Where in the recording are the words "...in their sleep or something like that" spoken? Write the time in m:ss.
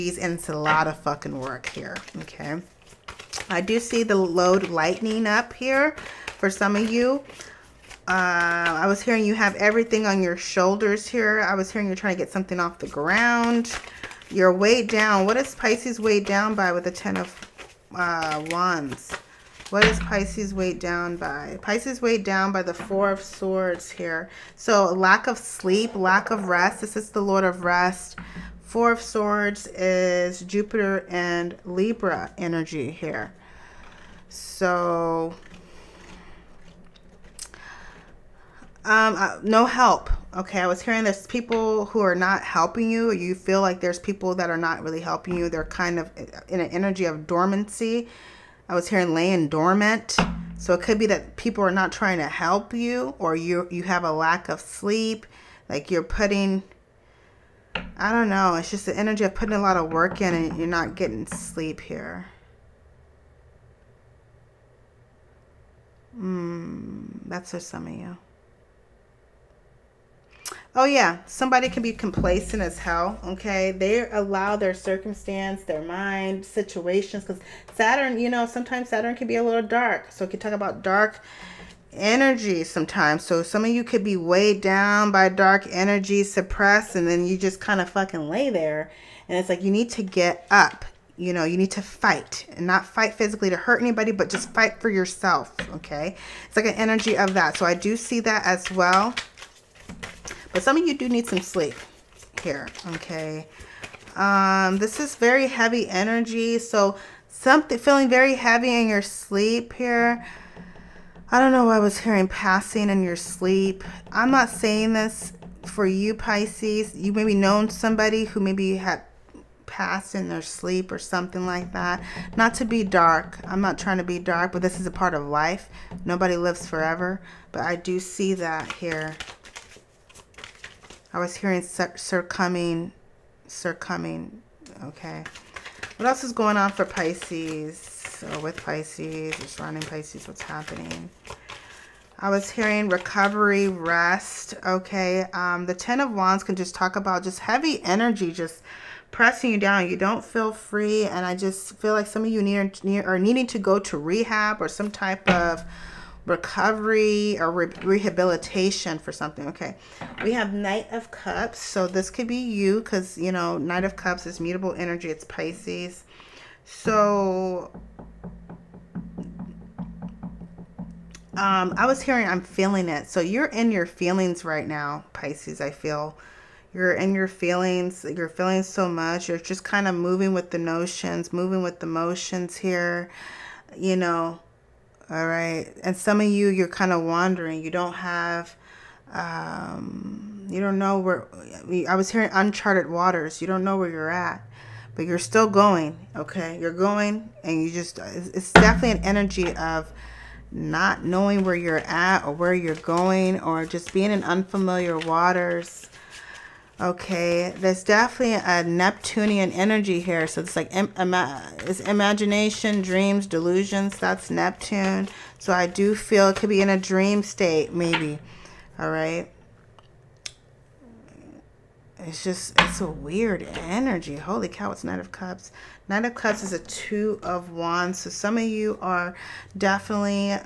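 2:00.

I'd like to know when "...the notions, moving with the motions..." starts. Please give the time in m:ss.
3:00.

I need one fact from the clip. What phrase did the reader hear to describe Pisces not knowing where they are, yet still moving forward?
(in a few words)
uncharted waters.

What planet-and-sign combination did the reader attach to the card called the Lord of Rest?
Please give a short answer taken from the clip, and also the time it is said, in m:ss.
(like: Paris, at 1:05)
Jupiter and Libra, at 0:30.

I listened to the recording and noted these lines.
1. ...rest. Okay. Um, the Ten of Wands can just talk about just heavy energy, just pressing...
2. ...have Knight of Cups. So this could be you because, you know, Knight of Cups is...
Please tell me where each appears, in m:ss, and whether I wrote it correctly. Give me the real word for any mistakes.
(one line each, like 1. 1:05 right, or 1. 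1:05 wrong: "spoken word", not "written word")
1. 2:23 right
2. 2:40 right.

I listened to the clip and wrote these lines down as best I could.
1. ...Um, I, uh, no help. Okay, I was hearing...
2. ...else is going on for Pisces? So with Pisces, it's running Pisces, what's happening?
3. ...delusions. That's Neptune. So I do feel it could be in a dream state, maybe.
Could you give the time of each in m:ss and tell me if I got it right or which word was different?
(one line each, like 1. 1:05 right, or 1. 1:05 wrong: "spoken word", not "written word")
1. 0:38 right
2. 2:16 right
3. 3:33 right.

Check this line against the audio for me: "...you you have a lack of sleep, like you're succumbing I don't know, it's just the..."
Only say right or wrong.
wrong.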